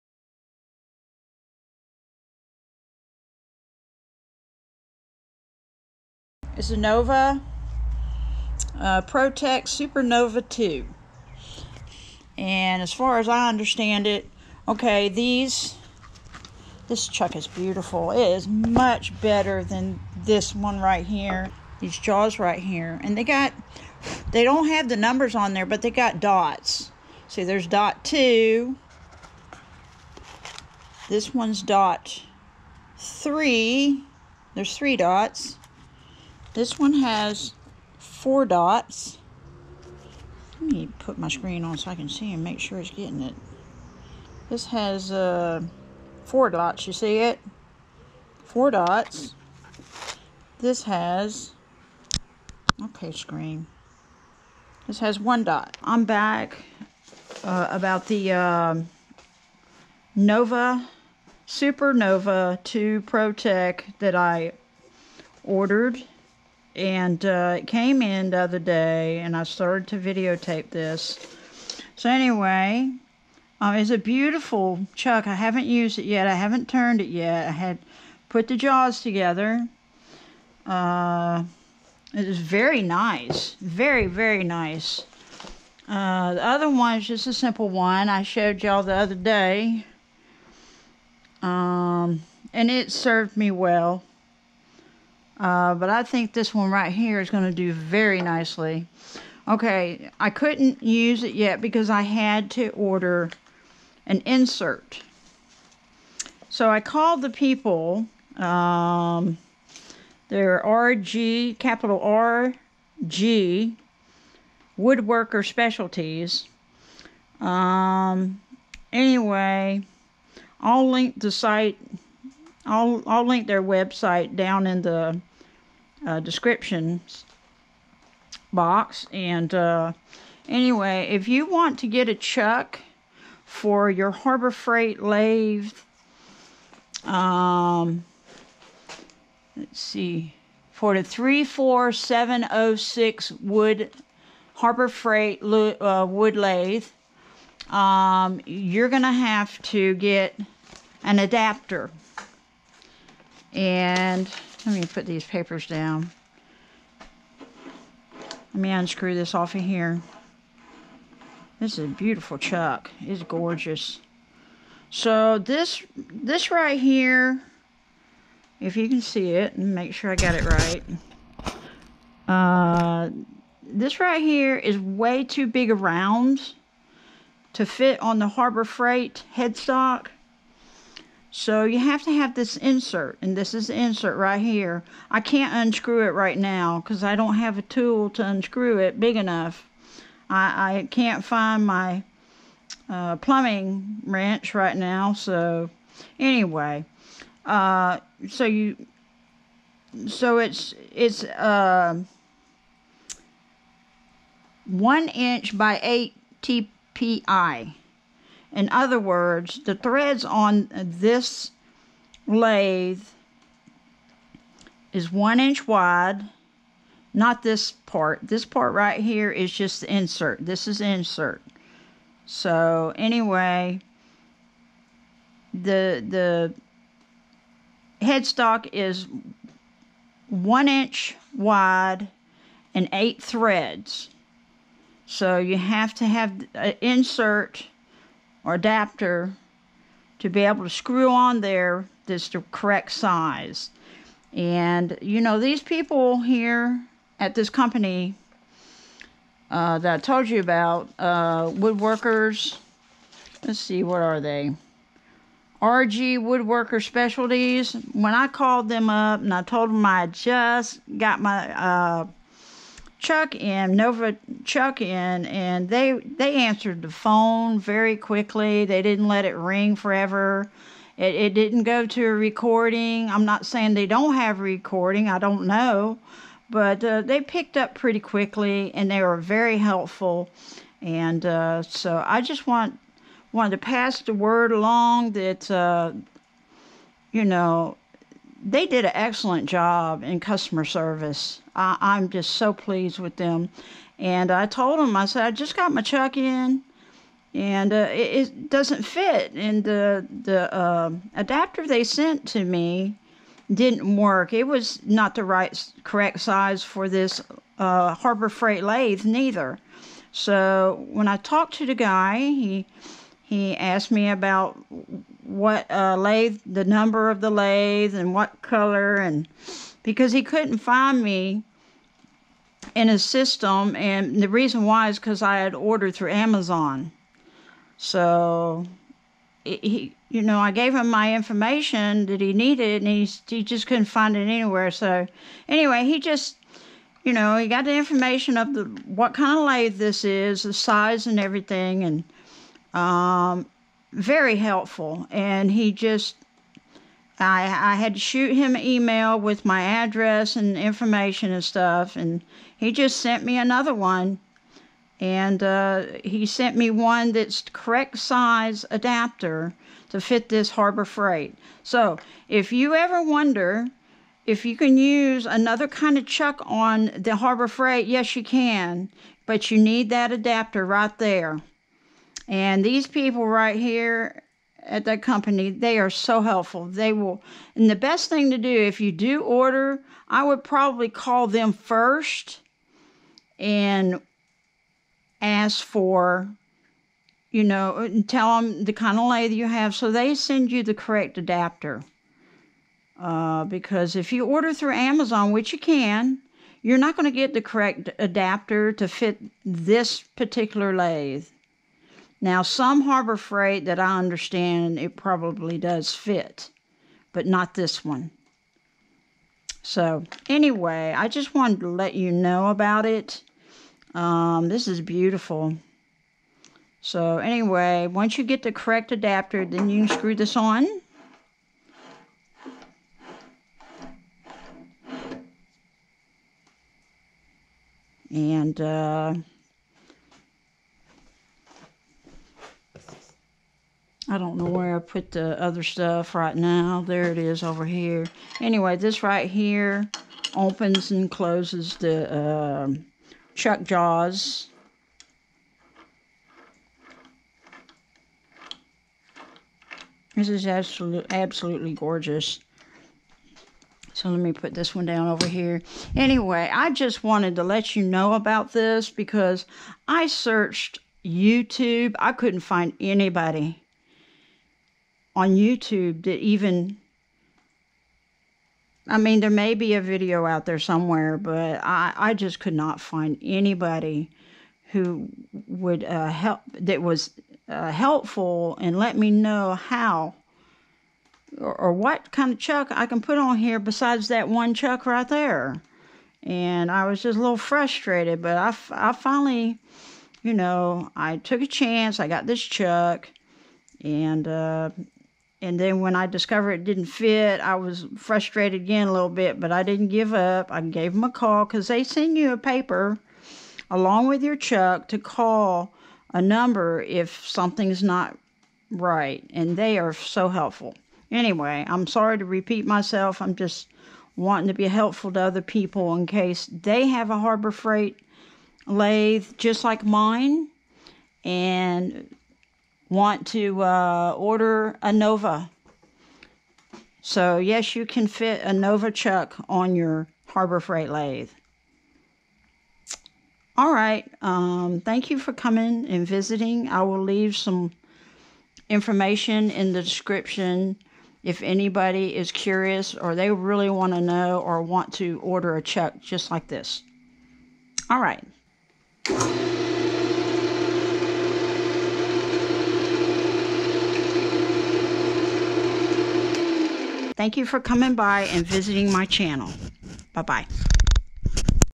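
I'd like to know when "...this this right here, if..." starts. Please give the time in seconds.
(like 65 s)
165 s.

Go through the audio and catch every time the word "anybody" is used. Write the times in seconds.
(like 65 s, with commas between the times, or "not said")
462 s, 473 s, 541 s.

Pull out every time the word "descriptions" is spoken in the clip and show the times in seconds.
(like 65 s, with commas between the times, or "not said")
126 s, 539 s.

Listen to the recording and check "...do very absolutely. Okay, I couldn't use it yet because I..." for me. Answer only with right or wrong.
wrong.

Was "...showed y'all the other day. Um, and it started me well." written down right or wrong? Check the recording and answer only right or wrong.
wrong.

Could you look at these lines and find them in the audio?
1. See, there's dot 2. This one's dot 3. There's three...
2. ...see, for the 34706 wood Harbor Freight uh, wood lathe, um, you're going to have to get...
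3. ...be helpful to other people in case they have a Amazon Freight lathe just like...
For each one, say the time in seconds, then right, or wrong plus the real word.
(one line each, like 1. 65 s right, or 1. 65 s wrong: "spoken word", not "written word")
1. 27 s right
2. 139 s right
3. 514 s wrong: "Harbor", not "Amazon".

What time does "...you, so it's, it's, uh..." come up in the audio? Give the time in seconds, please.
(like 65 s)
198 s.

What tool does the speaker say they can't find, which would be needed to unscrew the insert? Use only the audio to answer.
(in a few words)
plumbing wrench.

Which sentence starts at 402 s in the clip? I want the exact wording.
Now, some harbor freight that I understand it probably does fit, but not this one.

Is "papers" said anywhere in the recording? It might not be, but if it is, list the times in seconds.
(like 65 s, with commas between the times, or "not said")
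155 s, 502 s.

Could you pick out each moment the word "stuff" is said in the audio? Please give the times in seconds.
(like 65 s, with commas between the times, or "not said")
351 s, 435 s.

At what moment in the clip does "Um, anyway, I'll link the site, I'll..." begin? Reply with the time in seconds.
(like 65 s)
117 s.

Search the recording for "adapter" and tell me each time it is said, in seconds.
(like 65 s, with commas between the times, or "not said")
151 s, 238 s, 301 s, 358 s, 370 s, 391 s, 397 s, 418 s.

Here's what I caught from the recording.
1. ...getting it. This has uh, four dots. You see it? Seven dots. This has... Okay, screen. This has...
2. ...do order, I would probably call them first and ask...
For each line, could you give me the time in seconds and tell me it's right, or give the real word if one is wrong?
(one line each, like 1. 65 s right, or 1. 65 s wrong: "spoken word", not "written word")
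1. 42 s wrong: "Four", not "Seven"
2. 378 s right.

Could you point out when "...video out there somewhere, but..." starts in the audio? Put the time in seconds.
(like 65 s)
469 s.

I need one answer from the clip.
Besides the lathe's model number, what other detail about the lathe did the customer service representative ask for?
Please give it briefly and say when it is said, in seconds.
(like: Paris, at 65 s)
color, at 318 s.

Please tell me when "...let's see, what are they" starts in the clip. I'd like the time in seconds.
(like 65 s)
253 s.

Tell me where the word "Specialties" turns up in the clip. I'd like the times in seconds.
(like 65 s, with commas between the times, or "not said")
115 s, 256 s.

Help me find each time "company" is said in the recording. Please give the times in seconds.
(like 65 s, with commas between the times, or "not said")
247 s, 375 s.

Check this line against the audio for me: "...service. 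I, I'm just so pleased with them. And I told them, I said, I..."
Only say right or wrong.
right.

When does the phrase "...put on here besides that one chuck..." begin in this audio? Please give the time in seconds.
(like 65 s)
483 s.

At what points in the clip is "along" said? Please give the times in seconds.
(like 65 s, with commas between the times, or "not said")
284 s, 503 s.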